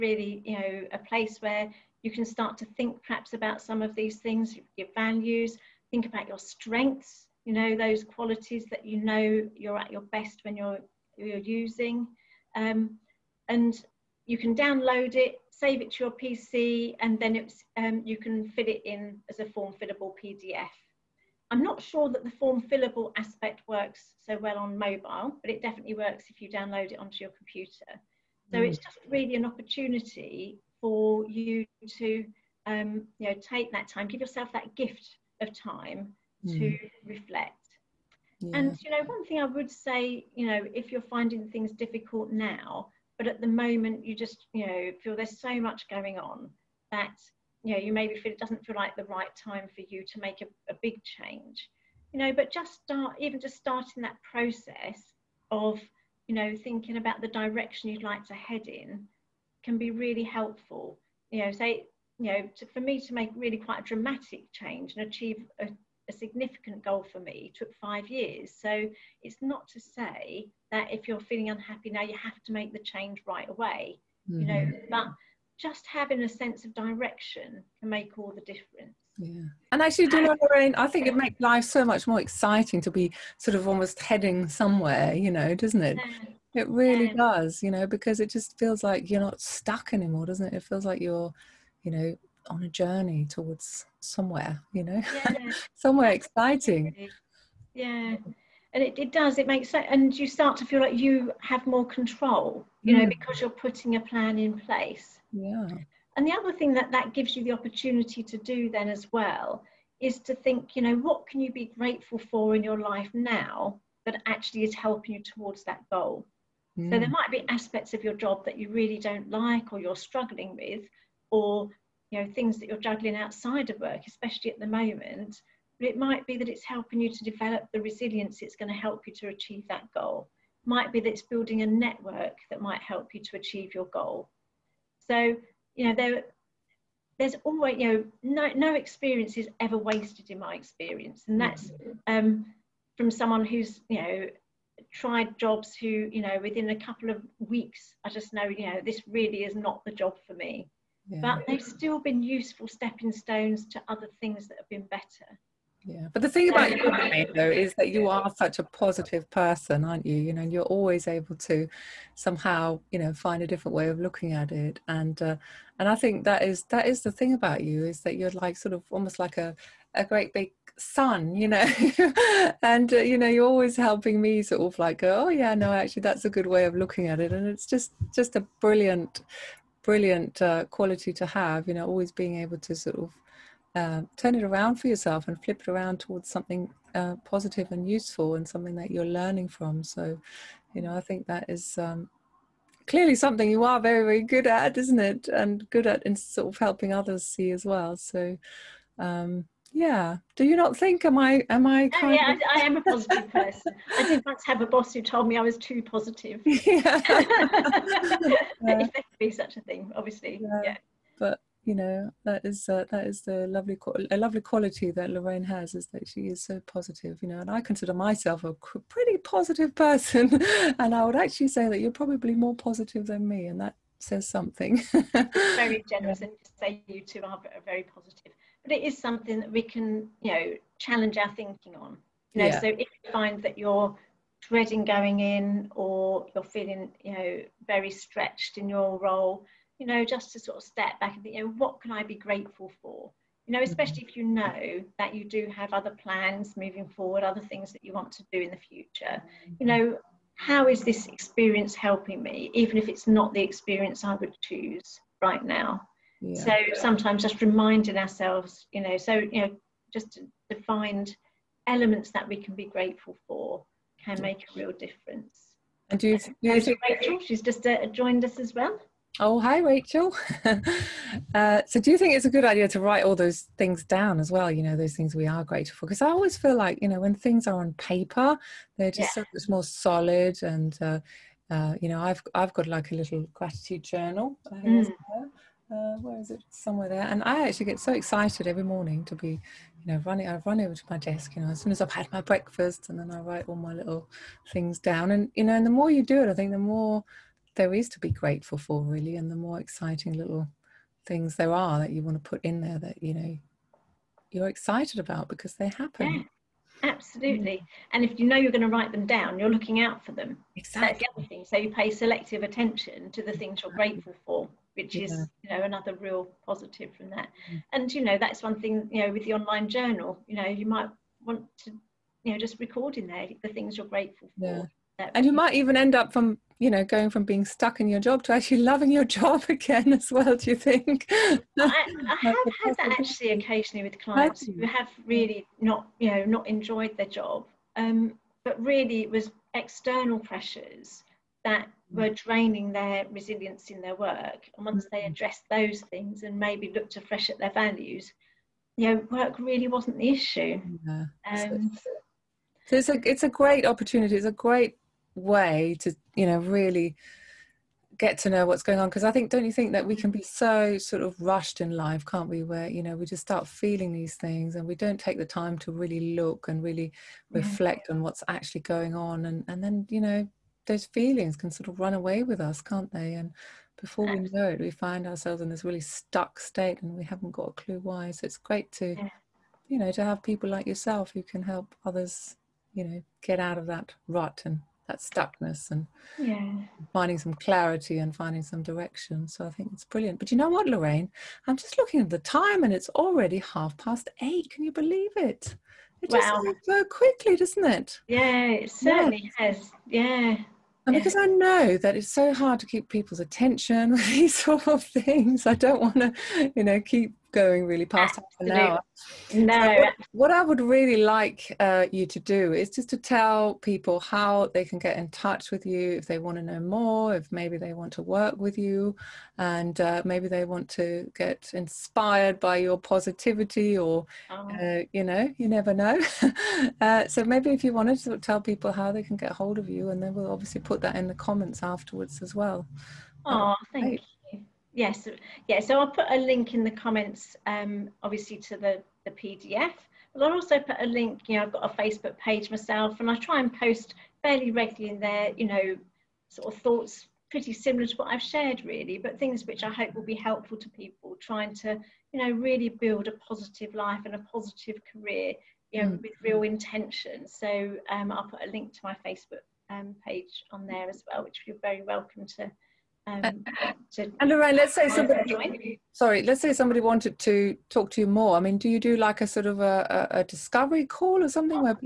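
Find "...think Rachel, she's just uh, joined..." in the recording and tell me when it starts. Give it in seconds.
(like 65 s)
266 s.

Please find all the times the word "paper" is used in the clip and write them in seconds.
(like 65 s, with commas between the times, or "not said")
277 s.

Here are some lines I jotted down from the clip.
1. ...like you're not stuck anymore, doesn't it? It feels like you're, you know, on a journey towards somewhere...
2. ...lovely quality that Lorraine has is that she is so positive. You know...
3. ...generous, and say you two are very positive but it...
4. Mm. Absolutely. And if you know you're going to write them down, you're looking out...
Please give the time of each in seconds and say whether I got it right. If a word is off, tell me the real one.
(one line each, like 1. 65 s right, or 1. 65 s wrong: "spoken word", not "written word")
1. 88 s right
2. 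214 s right
3. 225 s right
4. 306 s right.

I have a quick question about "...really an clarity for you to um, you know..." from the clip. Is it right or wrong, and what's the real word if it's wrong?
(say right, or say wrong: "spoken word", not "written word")
wrong: "opportunity", not "clarity".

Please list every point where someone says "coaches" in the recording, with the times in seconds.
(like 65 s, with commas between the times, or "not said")
not said.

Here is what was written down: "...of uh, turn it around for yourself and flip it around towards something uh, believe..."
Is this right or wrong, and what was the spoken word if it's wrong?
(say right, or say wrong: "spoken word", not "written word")
wrong: "positive", not "believe".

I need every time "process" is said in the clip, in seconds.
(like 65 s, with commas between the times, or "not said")
54 s.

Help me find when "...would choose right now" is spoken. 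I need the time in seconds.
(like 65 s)
254 s.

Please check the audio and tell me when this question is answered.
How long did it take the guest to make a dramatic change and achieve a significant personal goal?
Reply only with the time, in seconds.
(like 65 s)
67 s.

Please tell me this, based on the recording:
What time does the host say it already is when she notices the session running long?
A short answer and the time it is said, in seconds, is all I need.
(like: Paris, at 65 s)
Half past eight, at 393 s.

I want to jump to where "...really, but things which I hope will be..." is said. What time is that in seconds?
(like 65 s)
448 s.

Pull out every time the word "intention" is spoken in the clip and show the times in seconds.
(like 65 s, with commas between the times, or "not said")
456 s.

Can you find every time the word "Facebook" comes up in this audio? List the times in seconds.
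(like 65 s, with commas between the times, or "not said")
441 s, 459 s.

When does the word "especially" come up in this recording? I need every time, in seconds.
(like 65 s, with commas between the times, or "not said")
124 s, 243 s.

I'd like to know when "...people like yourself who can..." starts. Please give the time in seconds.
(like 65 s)
380 s.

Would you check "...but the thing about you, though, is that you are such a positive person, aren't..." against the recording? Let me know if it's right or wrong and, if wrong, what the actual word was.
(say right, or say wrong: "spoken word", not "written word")
right.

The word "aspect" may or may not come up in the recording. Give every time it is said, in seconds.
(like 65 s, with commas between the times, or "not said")
23 s, 117 s.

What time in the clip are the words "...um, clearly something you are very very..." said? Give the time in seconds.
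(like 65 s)
191 s.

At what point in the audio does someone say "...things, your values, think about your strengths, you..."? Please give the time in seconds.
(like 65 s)
4 s.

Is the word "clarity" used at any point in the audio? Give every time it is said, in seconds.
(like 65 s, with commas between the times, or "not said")
387 s.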